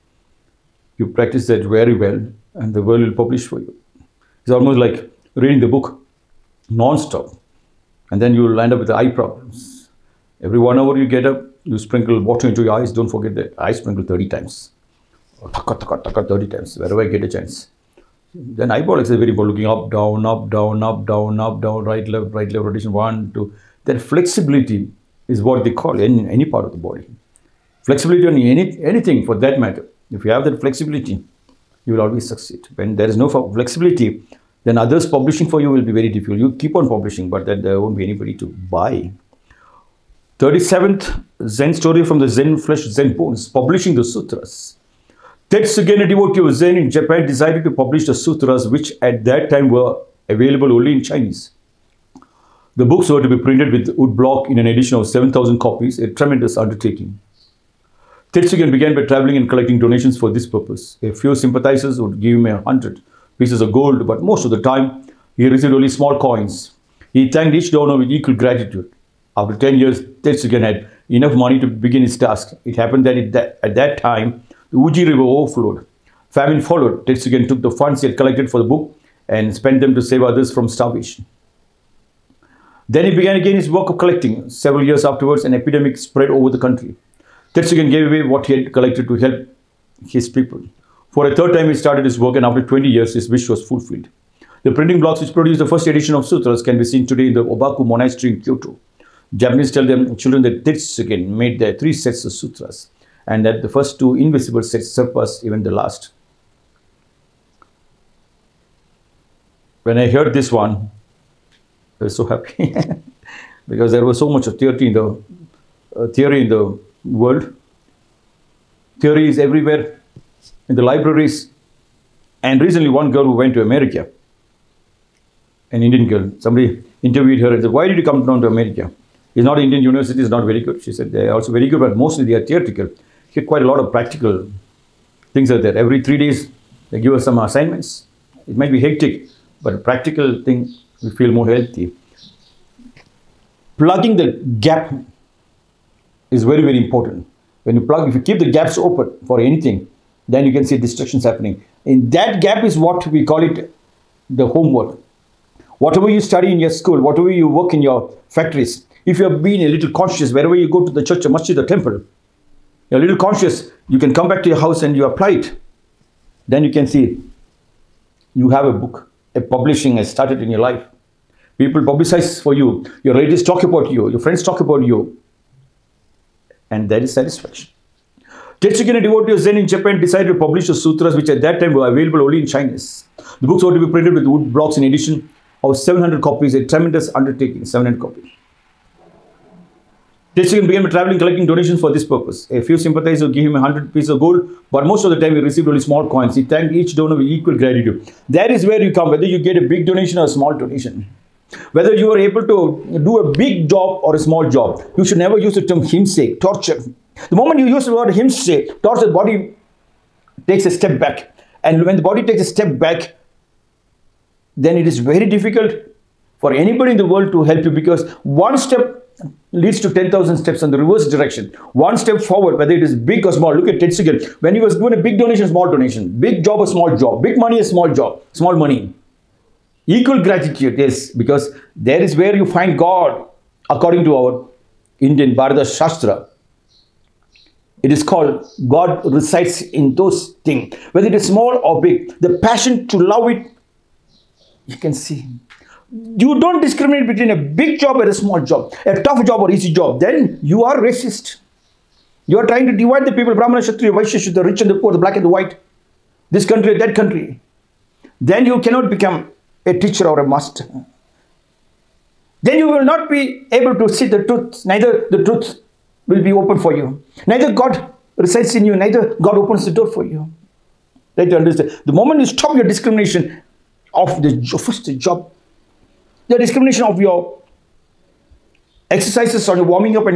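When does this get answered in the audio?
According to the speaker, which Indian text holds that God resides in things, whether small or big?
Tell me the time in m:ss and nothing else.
3:55.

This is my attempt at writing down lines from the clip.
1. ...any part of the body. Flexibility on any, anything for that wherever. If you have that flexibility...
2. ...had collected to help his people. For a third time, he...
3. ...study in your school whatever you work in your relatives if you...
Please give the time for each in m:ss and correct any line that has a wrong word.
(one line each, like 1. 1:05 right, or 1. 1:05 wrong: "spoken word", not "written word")
1. 0:26 wrong: "matter", not "wherever"
2. 1:28 right
3. 2:36 wrong: "factories", not "relatives".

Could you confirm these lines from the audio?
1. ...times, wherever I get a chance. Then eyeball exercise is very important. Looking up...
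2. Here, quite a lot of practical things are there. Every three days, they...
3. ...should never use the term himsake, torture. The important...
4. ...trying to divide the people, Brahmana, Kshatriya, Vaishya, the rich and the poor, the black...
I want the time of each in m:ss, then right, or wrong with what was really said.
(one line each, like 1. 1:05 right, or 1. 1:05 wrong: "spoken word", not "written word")
1. 0:16 right
2. 2:13 right
3. 3:25 wrong: "moment", not "important"
4. 4:12 right.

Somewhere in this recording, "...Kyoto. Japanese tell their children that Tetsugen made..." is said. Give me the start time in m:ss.
1:38.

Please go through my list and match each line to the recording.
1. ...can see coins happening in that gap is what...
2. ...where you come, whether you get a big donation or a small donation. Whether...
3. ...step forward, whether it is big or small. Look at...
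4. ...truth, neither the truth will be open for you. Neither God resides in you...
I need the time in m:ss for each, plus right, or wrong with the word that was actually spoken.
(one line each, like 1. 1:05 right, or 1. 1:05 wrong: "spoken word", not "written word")
1. 2:30 wrong: "distractions", not "coins"
2. 3:18 right
3. 3:41 right
4. 4:24 right.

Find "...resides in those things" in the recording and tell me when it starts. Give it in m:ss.
3:59.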